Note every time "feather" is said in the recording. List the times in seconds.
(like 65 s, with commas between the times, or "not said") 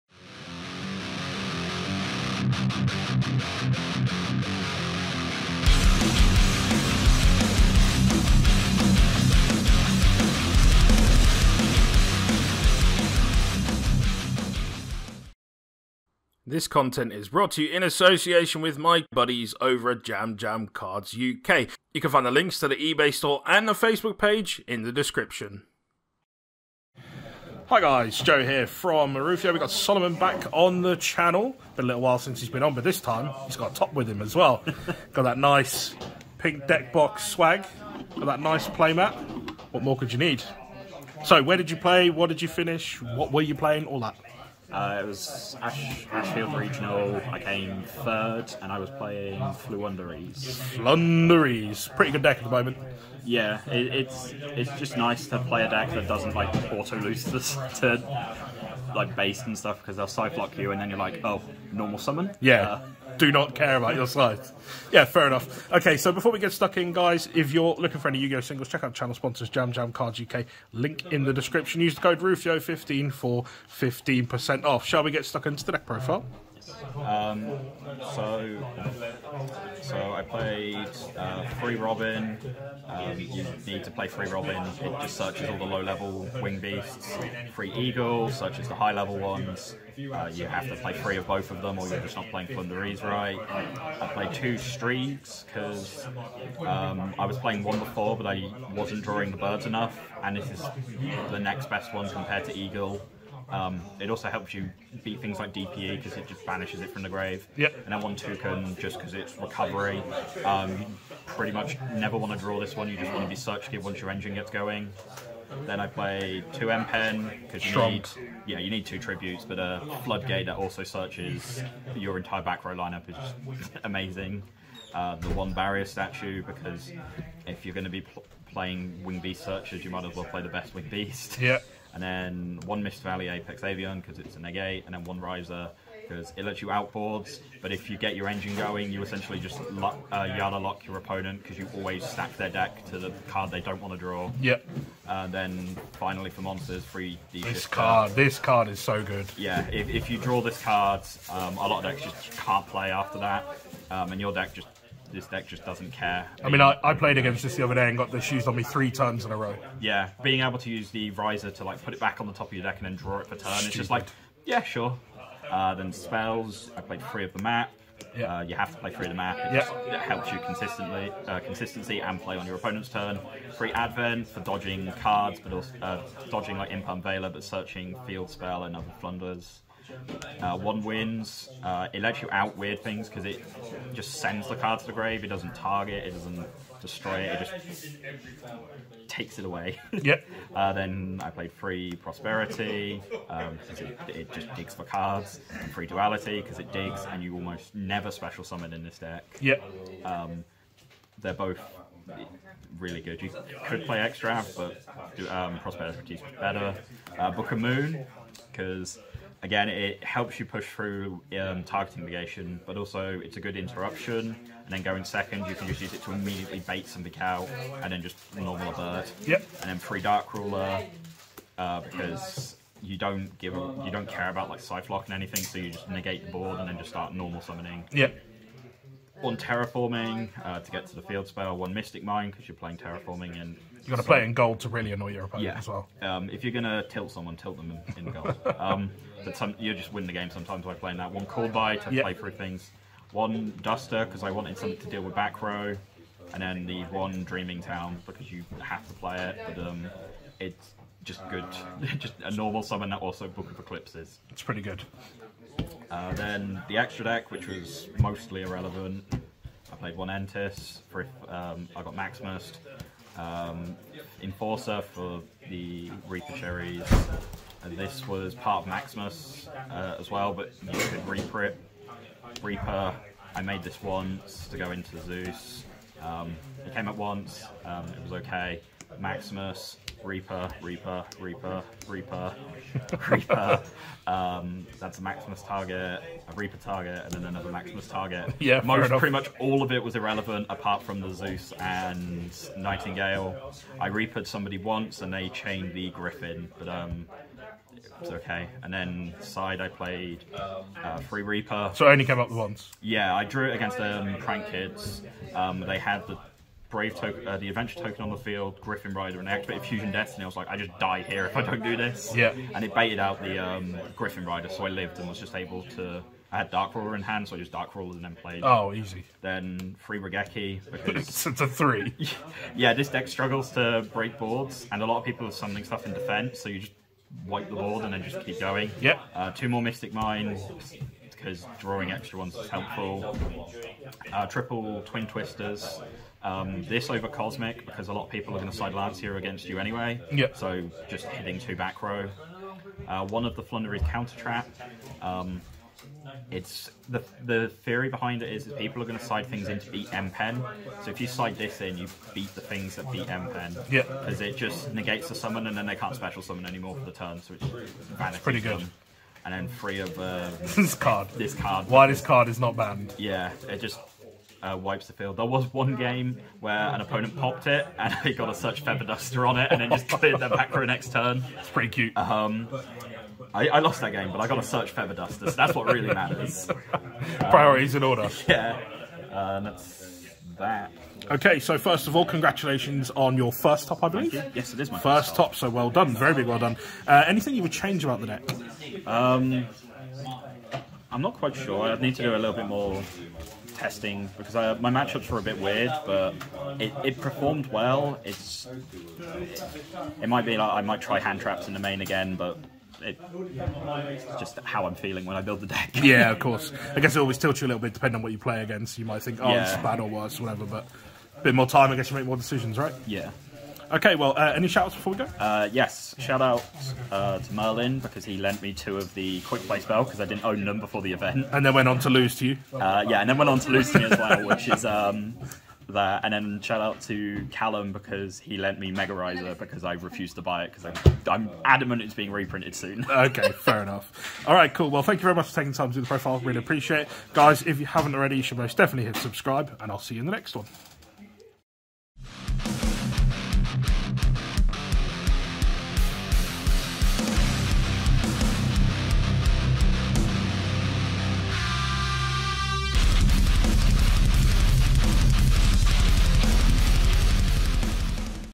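368 s, 374 s.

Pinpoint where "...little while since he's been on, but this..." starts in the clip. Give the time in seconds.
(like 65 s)
31 s.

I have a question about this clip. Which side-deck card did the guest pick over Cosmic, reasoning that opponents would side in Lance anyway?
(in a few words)
Twin Twisters.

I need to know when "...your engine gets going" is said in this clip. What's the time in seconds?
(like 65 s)
113 s.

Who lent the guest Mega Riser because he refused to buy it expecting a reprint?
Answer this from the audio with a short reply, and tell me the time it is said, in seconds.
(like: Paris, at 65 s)
Callum, at 427 s.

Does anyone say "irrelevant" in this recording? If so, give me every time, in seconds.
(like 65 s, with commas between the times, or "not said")
258 s, 289 s.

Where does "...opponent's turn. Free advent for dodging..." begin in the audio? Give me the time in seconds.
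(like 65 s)
172 s.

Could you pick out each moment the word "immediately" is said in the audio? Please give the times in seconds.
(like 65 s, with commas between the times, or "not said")
216 s.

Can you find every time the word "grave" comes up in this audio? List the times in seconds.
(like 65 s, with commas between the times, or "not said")
107 s, 184 s.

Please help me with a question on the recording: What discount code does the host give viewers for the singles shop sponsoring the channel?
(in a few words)
RUFIOH15.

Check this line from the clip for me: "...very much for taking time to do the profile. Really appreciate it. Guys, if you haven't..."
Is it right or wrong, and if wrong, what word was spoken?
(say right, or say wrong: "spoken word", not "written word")
right.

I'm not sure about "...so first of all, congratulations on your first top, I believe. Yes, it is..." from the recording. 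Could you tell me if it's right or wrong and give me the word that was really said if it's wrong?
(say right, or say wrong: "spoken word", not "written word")
right.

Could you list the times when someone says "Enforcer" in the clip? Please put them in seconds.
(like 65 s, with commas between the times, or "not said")
264 s.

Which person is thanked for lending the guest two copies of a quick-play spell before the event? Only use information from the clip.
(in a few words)
Merlin.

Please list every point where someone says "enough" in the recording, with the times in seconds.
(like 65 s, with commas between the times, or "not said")
65 s, 99 s, 433 s.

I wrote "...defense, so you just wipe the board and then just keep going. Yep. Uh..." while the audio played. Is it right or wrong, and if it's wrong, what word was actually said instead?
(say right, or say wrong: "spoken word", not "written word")
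right.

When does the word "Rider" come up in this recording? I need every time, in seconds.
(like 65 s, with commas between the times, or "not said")
308 s, 314 s.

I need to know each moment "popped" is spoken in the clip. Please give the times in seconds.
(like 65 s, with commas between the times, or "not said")
367 s.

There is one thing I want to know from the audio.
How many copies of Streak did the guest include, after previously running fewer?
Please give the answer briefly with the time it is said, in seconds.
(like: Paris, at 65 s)
2, at 94 s.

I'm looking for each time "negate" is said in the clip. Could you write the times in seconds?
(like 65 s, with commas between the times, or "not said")
134 s, 225 s, 354 s.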